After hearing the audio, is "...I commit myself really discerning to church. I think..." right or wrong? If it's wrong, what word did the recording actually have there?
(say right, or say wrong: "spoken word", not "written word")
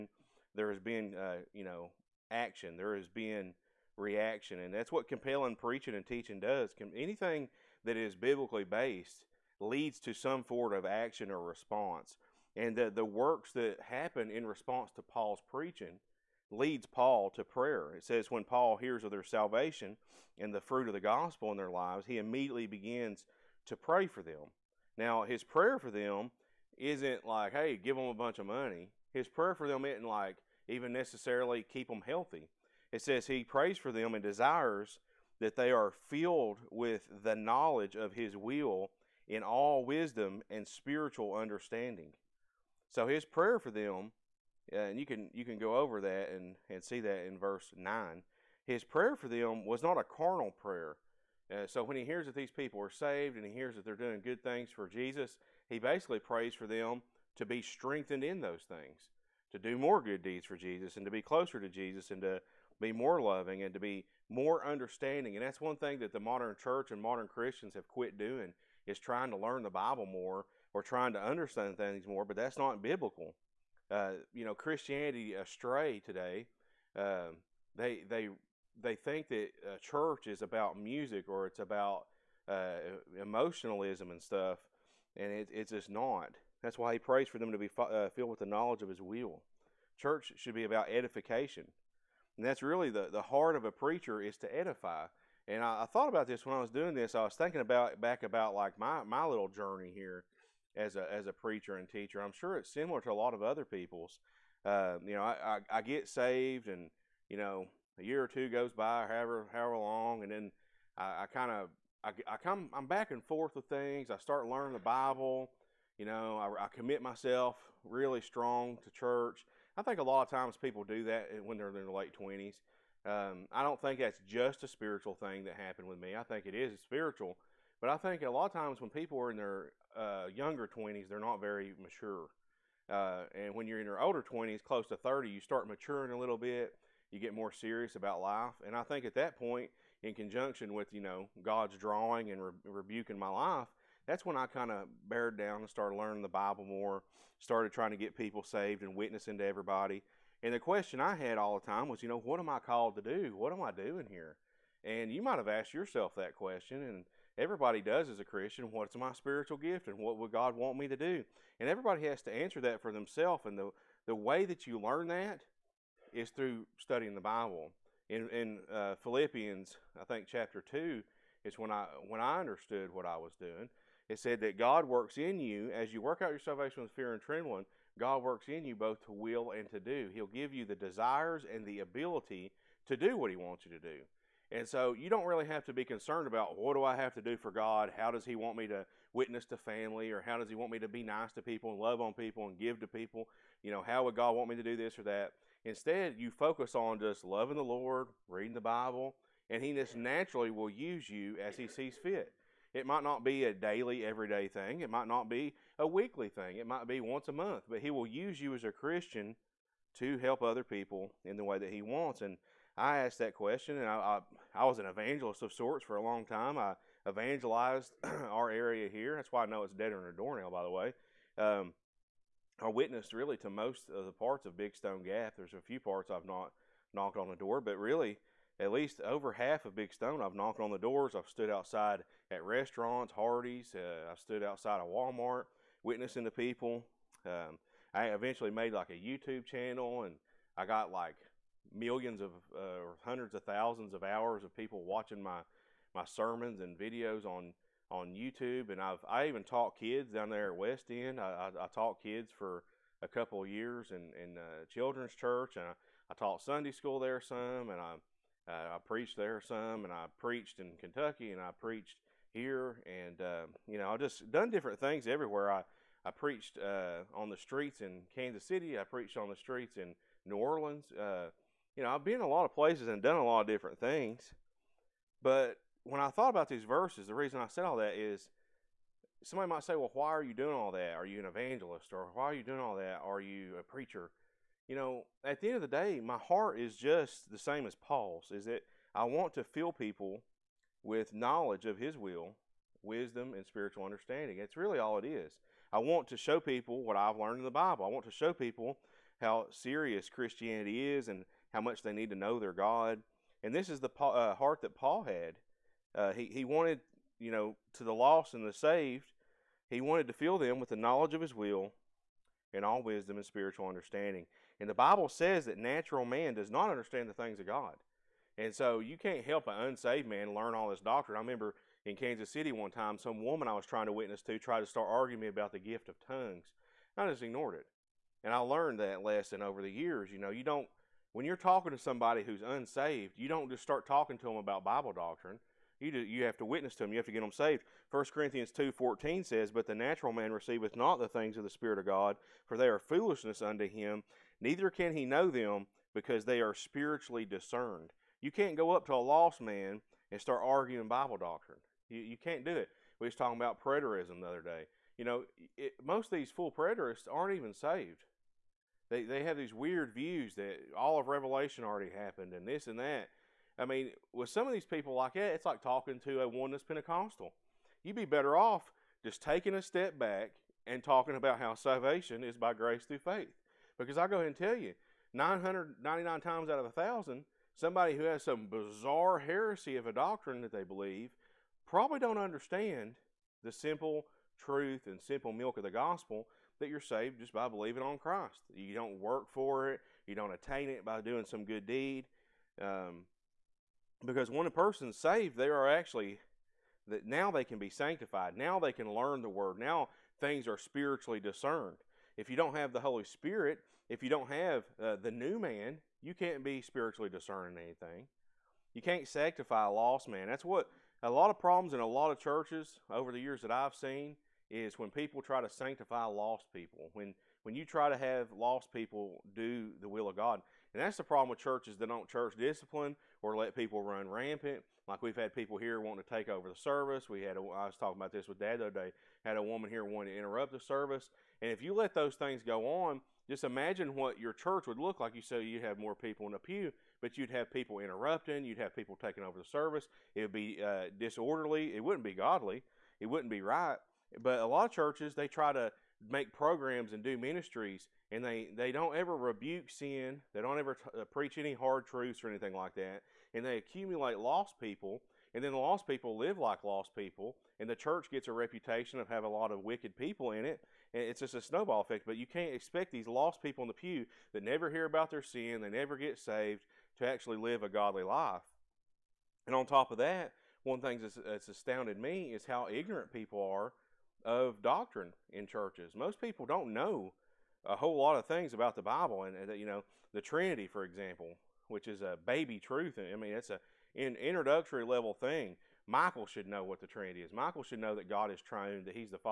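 wrong: "strong", not "discerning".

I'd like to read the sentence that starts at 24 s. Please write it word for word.
Now, his prayer for them isn't like, hey, give them a bunch of money.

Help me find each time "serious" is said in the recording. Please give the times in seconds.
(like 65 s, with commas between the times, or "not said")
137 s, 299 s.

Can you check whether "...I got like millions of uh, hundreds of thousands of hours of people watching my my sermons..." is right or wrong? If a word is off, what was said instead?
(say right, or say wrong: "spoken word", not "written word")
right.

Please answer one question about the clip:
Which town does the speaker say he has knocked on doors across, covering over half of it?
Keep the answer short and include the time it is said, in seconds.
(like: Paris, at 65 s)
Big Stone Gap, at 224 s.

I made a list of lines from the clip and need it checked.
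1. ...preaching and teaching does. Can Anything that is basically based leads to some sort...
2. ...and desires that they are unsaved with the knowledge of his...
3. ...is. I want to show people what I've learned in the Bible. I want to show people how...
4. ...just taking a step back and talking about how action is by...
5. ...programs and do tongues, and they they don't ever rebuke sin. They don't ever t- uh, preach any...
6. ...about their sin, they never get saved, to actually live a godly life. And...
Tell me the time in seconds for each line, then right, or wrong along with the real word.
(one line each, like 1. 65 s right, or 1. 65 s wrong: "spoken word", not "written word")
1. 5 s wrong: "biblically", not "basically"
2. 34 s wrong: "filled", not "unsaved"
3. 295 s right
4. 369 s wrong: "salvation", not "action"
5. 446 s wrong: "ministries", not "tongues"
6. 464 s right.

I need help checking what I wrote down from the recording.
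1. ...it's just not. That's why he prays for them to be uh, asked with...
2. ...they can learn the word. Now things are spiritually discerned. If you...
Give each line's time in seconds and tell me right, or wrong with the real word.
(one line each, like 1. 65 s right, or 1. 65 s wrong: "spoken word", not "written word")
1. 85 s wrong: "filled", not "asked"
2. 398 s right.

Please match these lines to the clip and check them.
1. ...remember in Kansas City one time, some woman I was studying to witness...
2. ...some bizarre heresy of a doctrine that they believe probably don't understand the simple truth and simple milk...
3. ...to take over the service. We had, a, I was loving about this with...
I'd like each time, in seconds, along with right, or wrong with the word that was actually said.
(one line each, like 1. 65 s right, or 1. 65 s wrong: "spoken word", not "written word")
1. 321 s wrong: "trying", not "studying"
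2. 378 s right
3. 426 s wrong: "talking", not "loving".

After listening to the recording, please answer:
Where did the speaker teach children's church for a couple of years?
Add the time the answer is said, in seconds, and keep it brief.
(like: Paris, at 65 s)
West End, at 250 s.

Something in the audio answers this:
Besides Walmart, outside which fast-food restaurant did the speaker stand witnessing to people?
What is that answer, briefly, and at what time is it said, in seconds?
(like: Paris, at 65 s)
Hardee's, at 233 s.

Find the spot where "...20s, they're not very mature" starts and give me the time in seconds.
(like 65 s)
130 s.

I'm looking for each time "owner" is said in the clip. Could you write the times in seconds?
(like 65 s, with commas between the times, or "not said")
not said.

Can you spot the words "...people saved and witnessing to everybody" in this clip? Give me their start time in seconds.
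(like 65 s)
148 s.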